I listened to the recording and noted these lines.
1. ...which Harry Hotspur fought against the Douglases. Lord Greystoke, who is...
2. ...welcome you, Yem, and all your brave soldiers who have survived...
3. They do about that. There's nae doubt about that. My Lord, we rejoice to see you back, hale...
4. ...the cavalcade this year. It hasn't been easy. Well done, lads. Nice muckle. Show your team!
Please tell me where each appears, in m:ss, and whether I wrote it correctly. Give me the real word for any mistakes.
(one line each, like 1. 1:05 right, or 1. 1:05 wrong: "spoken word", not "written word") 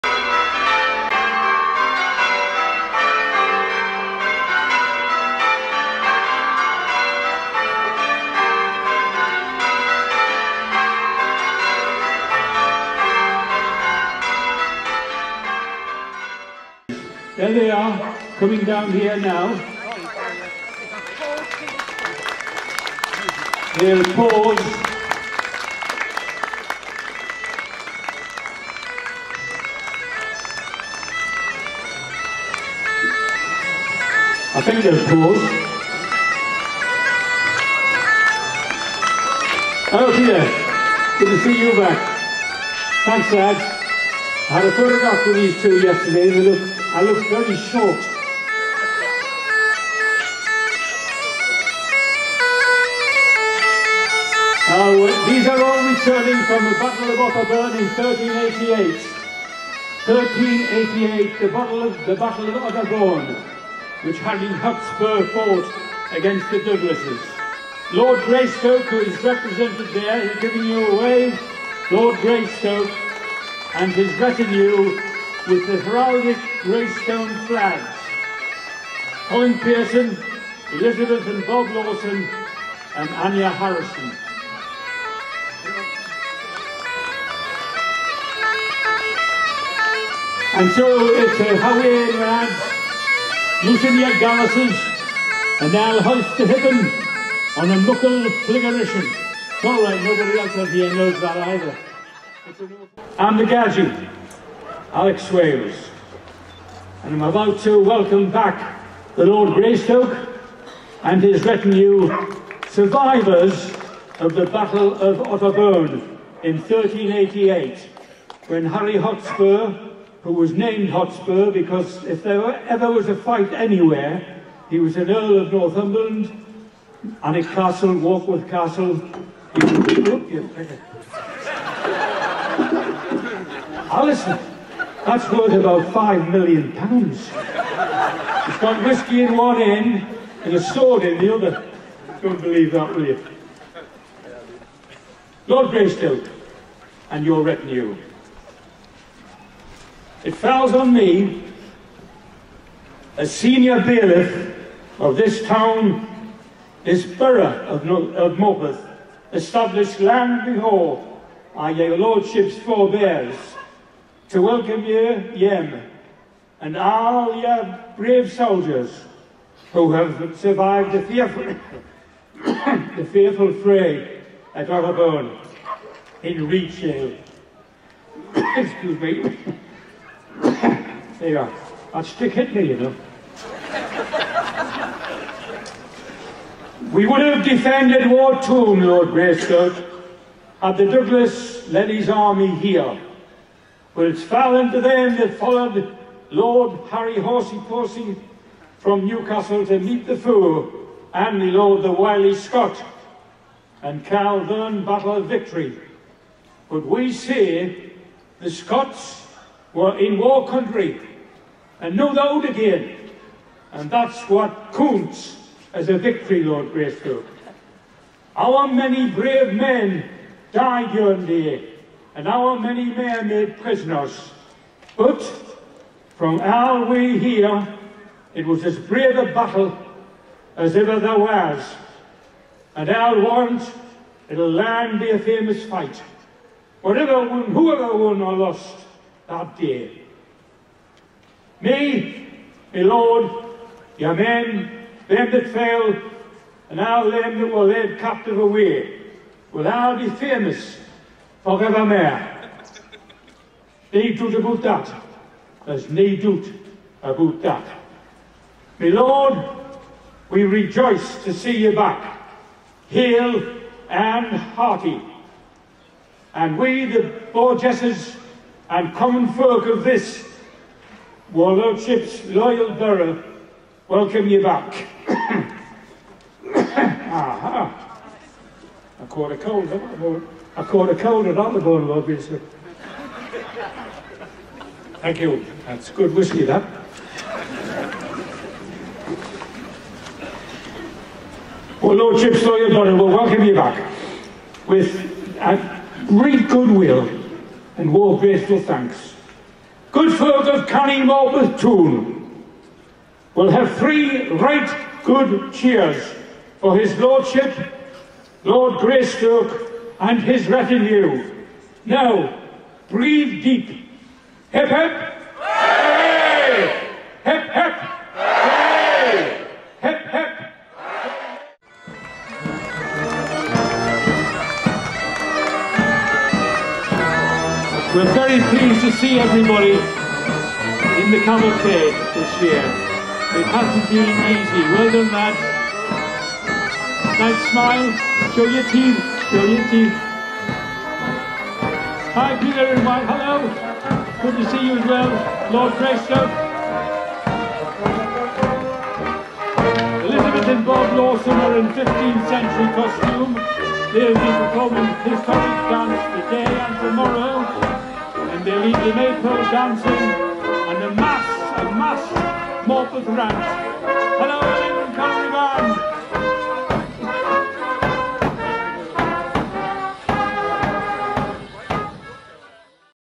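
1. 1:04 right
2. 2:44 right
3. 4:13 right
4. 5:31 wrong: "smile", not "muckle".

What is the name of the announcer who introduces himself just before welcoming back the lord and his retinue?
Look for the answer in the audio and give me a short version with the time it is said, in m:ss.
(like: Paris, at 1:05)
Alex Swales, at 1:44.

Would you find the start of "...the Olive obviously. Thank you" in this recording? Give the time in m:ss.
4:41.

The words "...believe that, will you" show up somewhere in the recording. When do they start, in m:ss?
2:22.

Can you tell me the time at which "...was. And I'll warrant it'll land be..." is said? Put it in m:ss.
3:51.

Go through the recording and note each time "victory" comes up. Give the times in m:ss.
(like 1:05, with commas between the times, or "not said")
3:25, 3:35.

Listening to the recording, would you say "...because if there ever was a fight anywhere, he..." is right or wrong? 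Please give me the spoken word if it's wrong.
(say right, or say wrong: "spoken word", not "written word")
right.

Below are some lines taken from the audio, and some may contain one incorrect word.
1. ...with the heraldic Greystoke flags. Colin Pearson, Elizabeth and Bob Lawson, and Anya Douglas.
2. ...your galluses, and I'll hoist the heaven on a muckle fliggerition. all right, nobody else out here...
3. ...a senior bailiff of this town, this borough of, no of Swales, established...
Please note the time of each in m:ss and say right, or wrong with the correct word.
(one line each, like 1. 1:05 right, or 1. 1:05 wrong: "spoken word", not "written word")
1. 1:15 wrong: "Harrison", not "Douglas"
2. 1:33 right
3. 2:33 wrong: "Morpeth", not "Swales".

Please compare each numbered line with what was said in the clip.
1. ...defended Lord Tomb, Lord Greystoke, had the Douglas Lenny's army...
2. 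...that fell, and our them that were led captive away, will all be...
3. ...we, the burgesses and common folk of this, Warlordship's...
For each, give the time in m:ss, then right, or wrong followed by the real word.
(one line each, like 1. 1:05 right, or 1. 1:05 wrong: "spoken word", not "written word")
1. 3:07 wrong: "War", not "Lord"
2. 4:05 right
3. 4:26 right.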